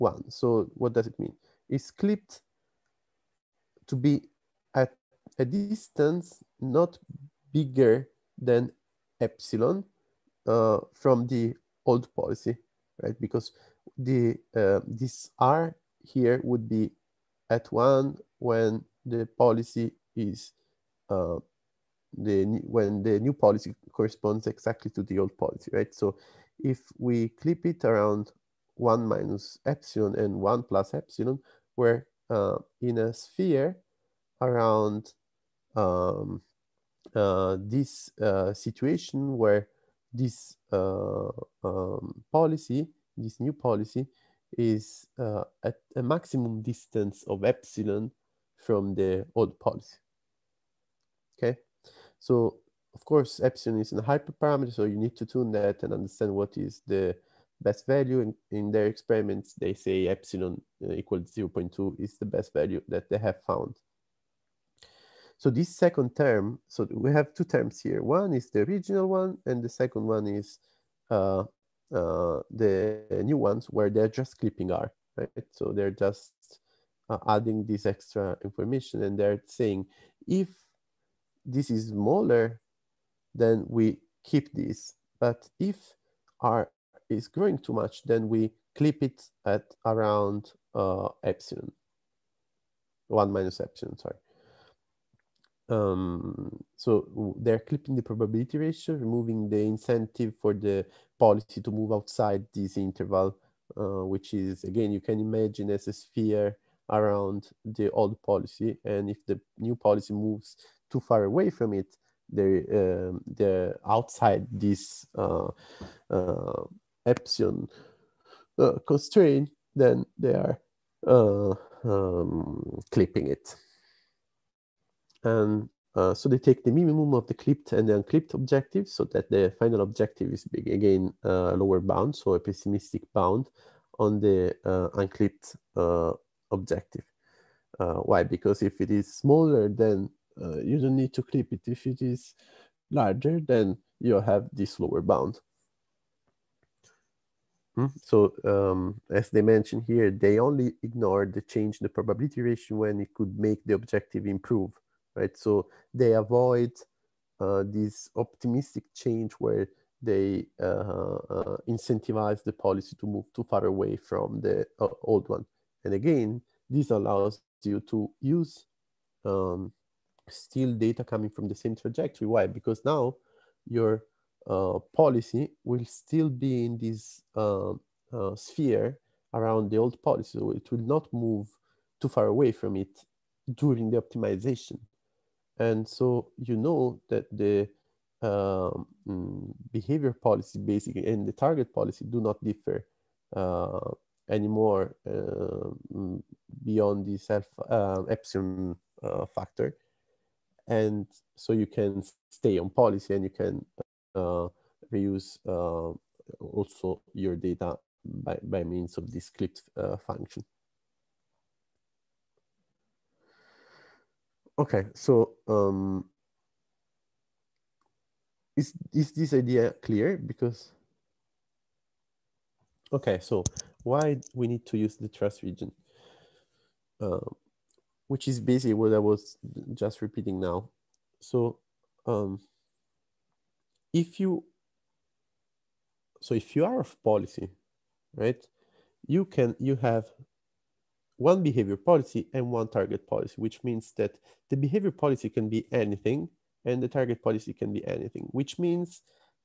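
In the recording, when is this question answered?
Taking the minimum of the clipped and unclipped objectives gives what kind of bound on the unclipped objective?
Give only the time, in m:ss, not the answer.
2:12.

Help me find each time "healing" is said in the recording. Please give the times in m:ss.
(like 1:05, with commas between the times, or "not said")
not said.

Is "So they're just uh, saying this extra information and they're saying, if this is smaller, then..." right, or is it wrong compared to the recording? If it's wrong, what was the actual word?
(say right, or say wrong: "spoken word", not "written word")
wrong: "adding", not "saying".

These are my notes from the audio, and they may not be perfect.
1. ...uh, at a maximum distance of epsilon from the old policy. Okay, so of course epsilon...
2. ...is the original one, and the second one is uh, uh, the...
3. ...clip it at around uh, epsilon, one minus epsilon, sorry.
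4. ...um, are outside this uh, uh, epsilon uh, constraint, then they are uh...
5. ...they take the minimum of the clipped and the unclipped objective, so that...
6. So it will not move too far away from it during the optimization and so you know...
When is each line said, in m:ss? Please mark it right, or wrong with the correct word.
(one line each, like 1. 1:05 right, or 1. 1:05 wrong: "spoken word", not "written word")
1. 0:45 right
2. 1:08 right
3. 1:28 right
4. 1:52 right
5. 2:06 right
6. 3:00 right.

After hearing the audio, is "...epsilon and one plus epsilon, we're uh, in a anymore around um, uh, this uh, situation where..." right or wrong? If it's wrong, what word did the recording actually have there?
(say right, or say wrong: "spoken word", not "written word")
wrong: "sphere", not "anymore".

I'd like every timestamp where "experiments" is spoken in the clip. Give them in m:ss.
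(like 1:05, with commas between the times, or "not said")
0:58.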